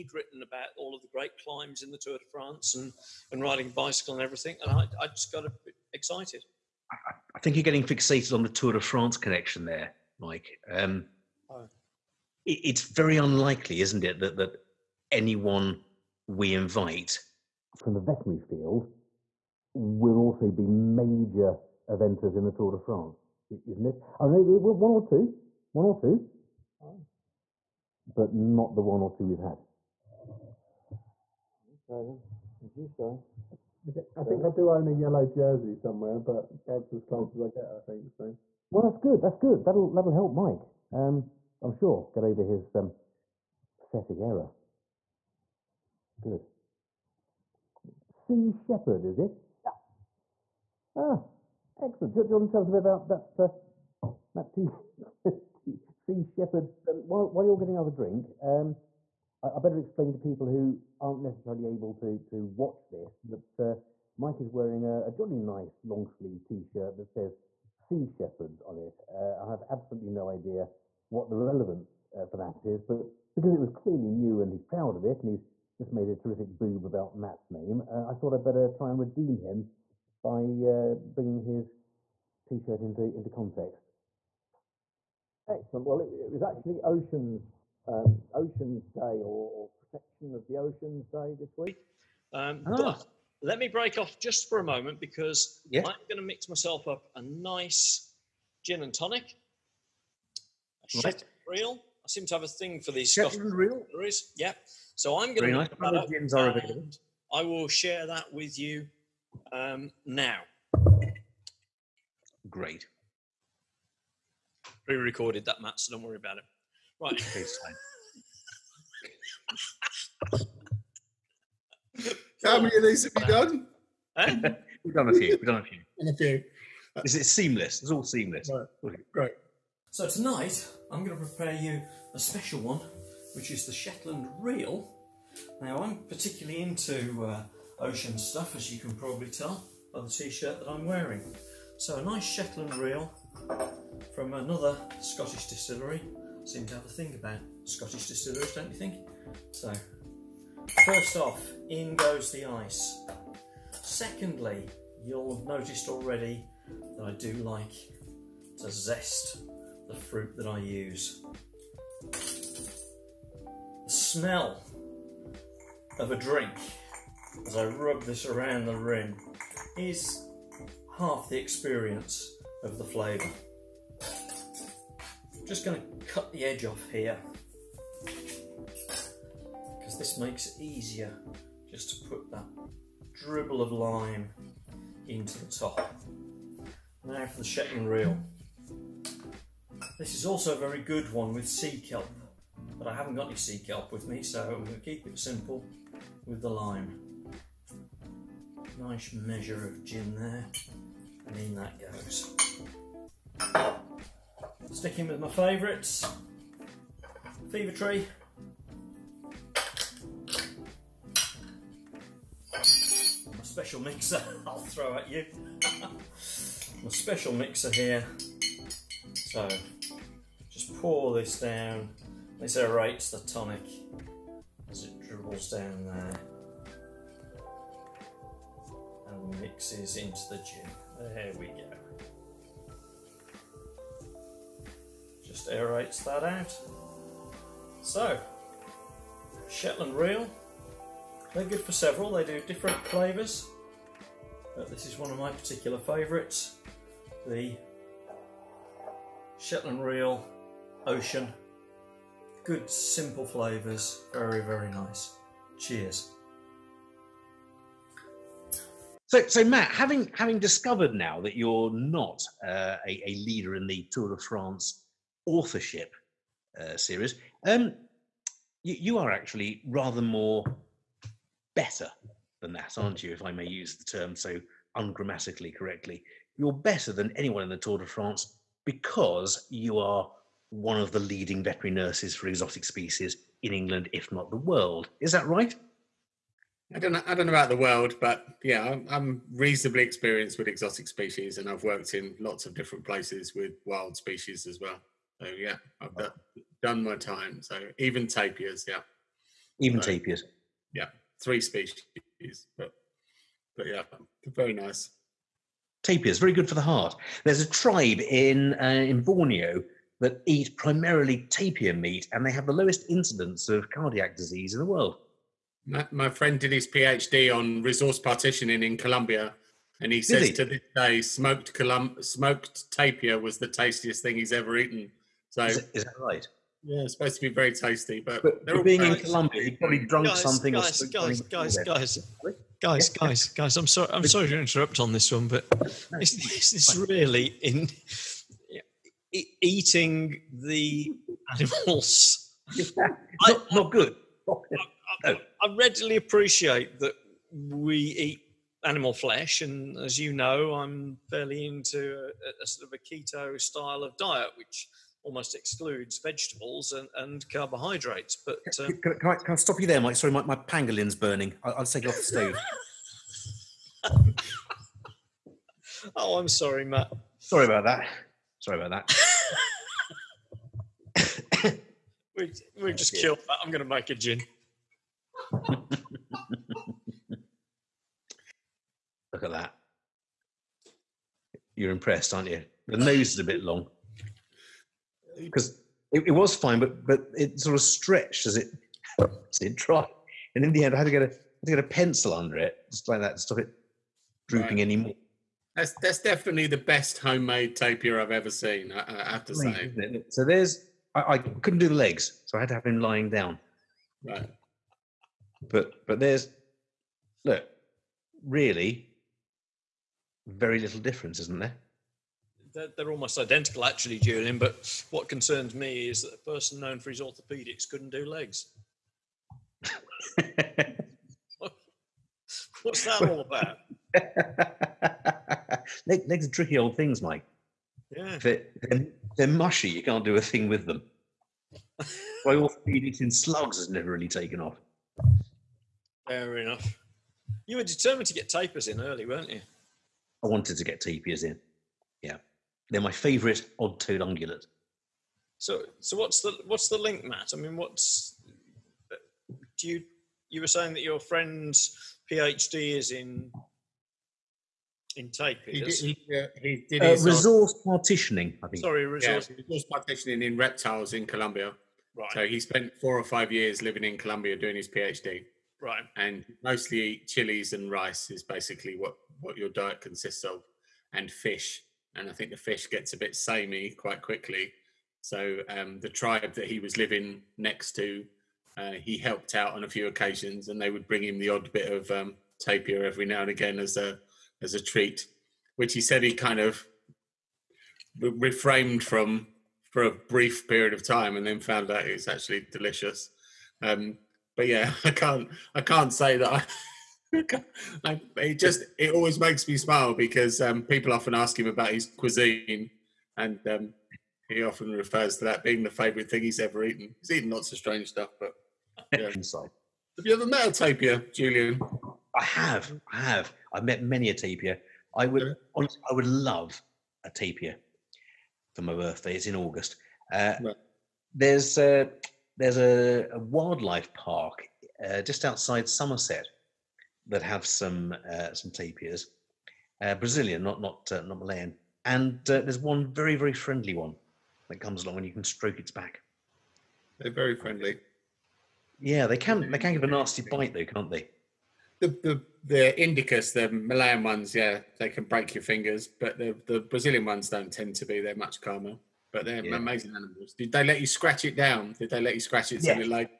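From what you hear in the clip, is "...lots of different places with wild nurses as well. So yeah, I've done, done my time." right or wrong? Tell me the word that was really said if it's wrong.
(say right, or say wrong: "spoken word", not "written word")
wrong: "species", not "nurses".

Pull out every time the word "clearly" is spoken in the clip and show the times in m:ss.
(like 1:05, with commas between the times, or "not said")
1:13.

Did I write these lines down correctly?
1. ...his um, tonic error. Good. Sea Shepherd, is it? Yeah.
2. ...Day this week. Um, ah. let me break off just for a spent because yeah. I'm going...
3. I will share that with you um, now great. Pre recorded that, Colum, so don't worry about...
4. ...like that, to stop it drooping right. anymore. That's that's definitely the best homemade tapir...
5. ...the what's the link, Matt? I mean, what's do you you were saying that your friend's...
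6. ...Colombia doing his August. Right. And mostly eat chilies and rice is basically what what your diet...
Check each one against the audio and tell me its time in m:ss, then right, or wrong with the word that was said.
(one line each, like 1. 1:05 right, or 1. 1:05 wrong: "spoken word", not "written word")
1. 0:42 wrong: "pathetic", not "tonic"
2. 1:31 wrong: "moment", not "spent"
3. 1:47 wrong: "Matt", not "Colum"
4. 6:32 right
5. 7:26 right
6. 7:43 wrong: "PhD", not "August".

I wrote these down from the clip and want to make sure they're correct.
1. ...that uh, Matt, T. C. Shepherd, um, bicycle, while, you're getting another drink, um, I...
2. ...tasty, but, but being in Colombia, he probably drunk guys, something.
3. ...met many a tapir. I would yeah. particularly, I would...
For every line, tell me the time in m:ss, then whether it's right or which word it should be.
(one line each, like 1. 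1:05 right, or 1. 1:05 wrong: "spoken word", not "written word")
1. 0:53 wrong: "while", not "bicycle"
2. 5:27 right
3. 8:33 wrong: "honestly", not "particularly".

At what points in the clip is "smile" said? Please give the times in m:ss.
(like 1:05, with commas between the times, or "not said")
8:19.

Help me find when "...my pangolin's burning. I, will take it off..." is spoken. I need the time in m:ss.
6:00.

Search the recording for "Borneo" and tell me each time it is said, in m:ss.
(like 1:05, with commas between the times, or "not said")
5:09.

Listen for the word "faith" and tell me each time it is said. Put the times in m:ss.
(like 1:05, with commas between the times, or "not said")
not said.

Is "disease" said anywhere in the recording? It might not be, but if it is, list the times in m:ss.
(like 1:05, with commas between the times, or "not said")
5:14.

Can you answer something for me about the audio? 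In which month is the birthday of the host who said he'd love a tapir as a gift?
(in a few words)
August.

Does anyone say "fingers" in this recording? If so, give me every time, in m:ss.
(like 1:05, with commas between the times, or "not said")
9:05.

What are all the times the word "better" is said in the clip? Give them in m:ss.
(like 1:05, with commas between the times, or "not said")
0:59, 1:18, 4:31, 4:36.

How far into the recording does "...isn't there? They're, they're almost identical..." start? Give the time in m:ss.
6:51.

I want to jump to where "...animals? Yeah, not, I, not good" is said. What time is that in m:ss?
5:41.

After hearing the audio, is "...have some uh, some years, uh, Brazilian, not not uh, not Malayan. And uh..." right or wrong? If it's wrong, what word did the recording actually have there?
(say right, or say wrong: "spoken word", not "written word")
wrong: "tapirs", not "years".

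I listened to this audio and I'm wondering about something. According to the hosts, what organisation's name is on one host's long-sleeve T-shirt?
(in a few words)
Sea Shepherd.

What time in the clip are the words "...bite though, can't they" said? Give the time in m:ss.
9:00.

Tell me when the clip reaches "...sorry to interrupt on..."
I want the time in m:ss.
5:34.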